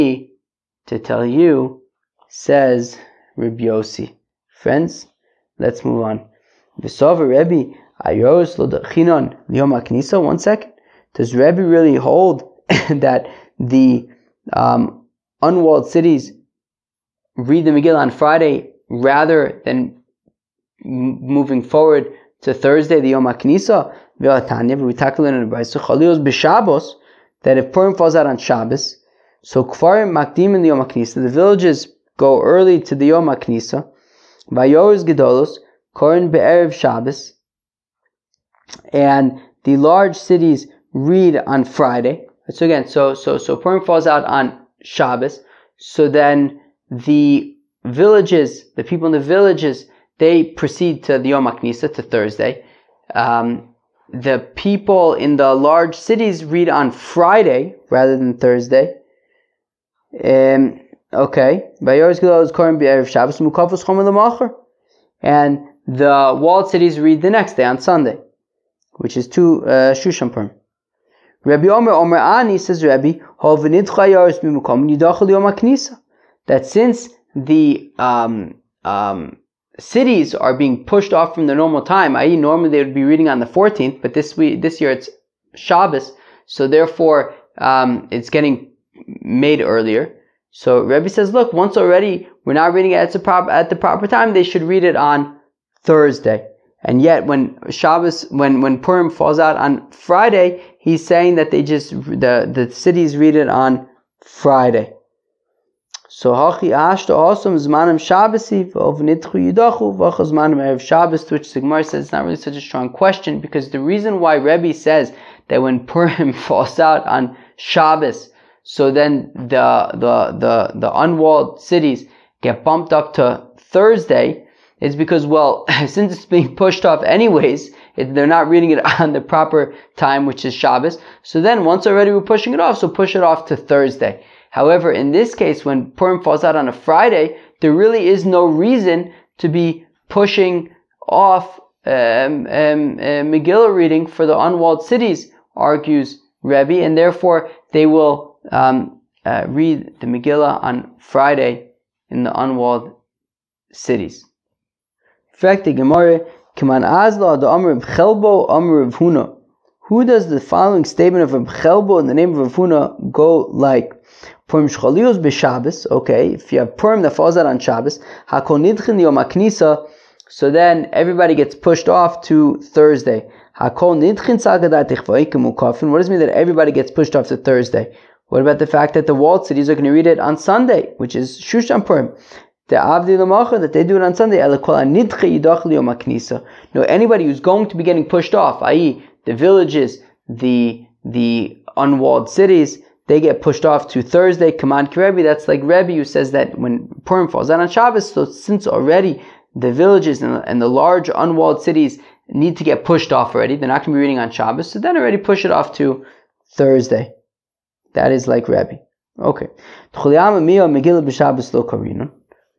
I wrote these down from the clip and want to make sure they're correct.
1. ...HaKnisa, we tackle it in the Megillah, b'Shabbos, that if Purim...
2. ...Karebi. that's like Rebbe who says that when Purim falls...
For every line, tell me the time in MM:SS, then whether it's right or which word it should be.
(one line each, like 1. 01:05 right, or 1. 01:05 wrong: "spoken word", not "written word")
1. 00:23 wrong: "Brisa", not "Megillah"
2. 03:14 right.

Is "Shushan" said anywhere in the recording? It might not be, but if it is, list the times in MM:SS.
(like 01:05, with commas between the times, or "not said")
01:09, 03:01.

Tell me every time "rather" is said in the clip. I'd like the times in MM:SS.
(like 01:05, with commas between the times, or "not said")
00:18, 00:57.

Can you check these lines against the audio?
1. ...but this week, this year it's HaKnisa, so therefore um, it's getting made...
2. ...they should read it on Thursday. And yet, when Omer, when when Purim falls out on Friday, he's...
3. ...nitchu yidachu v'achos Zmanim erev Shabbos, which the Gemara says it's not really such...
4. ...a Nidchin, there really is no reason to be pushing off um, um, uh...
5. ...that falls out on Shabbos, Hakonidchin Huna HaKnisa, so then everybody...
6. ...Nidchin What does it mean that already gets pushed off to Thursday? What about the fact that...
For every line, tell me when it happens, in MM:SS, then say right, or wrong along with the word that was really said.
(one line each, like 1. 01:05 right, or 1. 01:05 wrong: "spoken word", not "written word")
1. 01:24 wrong: "Shabbos", not "HaKnisa"
2. 01:34 wrong: "Shabbos", not "Omer"
3. 01:48 right
4. 02:16 wrong: "Friday", not "Nidchin"
5. 02:47 wrong: "Yom", not "Huna"
6. 02:53 wrong: "everybody", not "already".